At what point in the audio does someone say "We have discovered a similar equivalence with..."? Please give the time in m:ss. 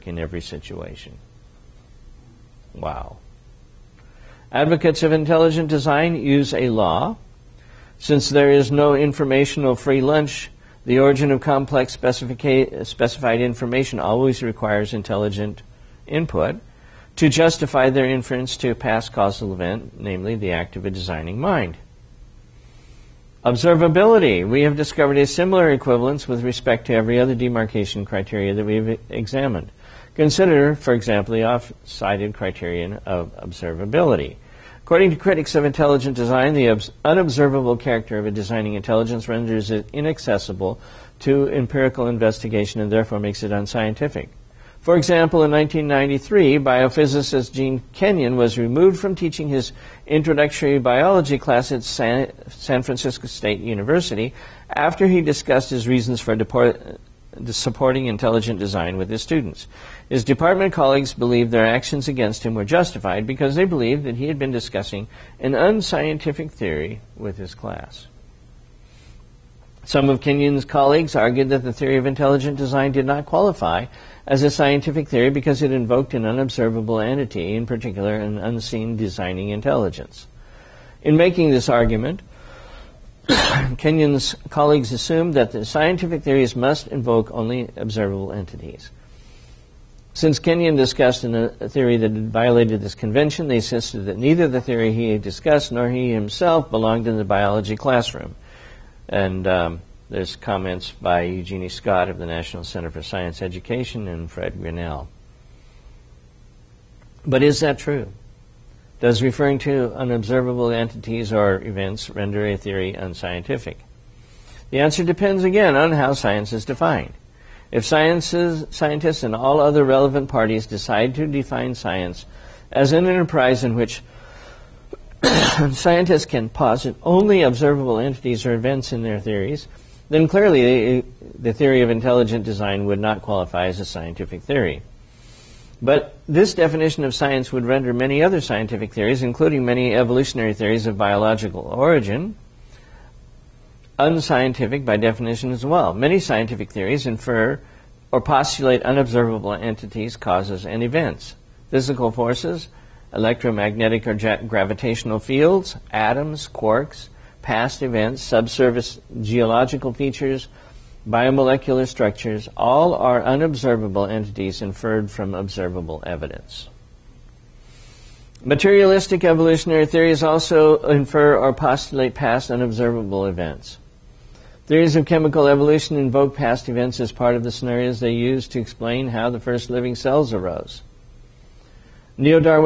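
0:24.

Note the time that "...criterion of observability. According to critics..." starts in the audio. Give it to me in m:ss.
0:32.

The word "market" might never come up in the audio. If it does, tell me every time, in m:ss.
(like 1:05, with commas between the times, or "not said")
not said.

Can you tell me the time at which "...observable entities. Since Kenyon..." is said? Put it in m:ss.
1:27.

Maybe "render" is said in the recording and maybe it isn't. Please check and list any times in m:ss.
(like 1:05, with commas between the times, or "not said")
0:39, 1:52, 2:17.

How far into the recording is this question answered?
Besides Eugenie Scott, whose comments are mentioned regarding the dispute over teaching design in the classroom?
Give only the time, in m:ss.
1:44.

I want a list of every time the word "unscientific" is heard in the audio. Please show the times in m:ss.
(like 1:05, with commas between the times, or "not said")
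0:43, 1:05, 1:52, 2:23.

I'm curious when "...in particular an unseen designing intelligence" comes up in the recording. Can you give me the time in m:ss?
1:17.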